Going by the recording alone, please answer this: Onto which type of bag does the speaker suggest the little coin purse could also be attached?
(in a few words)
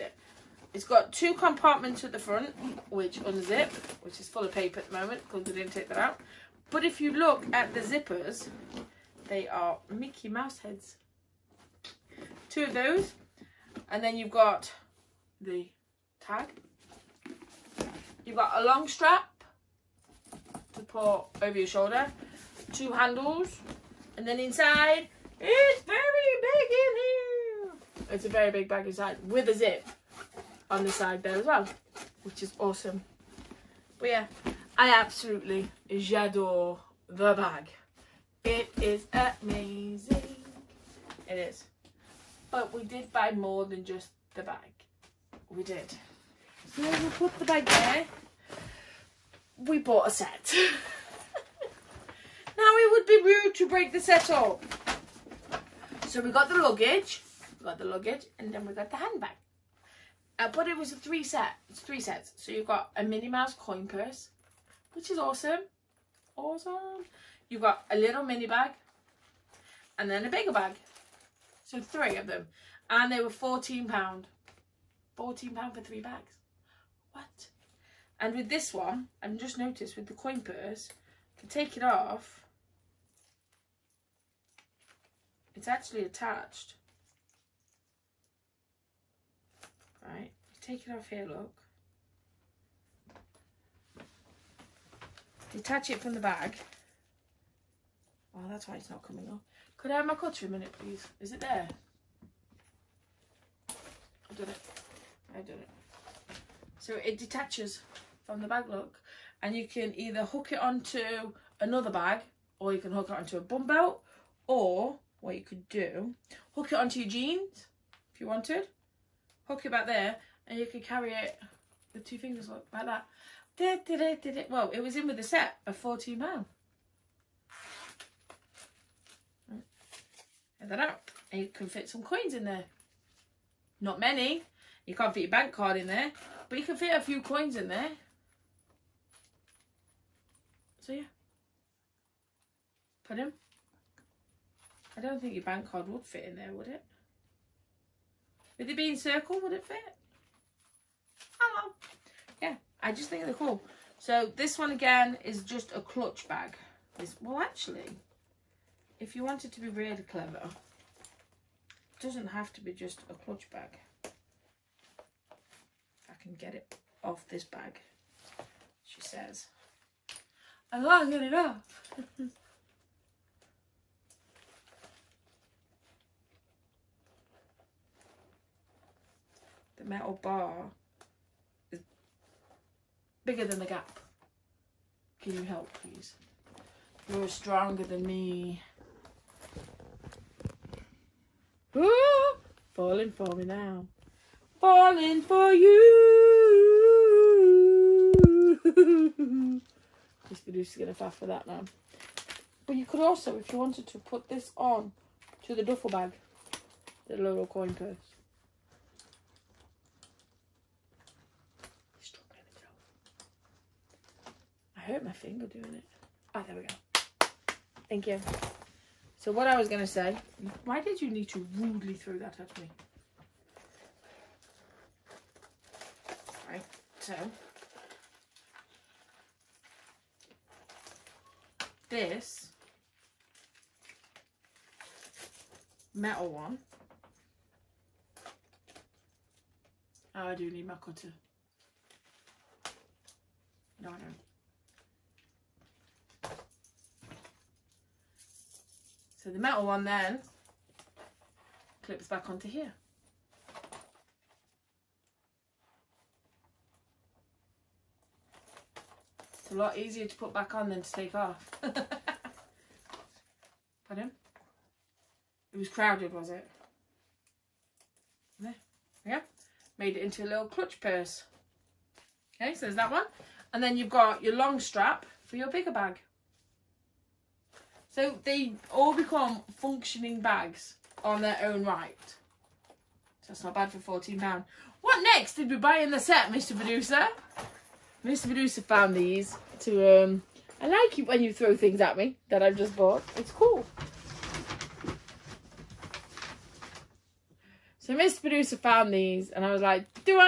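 duffel bag.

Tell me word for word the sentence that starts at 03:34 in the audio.
I hurt my finger doing it.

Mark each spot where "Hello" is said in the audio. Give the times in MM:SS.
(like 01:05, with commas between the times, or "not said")
02:31.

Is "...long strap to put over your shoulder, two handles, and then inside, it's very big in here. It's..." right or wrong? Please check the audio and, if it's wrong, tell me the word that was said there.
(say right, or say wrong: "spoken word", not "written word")
right.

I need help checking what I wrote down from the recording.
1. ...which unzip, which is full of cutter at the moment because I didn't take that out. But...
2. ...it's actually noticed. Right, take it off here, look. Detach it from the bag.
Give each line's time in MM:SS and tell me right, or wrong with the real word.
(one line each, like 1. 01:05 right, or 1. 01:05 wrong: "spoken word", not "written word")
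1. 00:02 wrong: "paper", not "cutter"
2. 01:25 wrong: "attached", not "noticed".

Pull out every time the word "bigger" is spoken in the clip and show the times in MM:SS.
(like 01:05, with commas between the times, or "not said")
01:10, 03:03, 04:35.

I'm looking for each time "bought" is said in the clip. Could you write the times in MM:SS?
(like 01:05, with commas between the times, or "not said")
00:49, 04:52.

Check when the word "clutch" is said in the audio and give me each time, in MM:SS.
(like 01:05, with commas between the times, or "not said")
02:35, 02:43, 04:30.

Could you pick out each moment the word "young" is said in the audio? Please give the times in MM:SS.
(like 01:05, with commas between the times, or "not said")
not said.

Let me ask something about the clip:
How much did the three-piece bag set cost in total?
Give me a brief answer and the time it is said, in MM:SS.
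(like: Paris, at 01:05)
£14, at 01:15.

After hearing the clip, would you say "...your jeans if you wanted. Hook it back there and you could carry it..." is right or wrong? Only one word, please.
right.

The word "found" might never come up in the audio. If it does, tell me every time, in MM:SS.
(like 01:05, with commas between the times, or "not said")
04:48, 04:58.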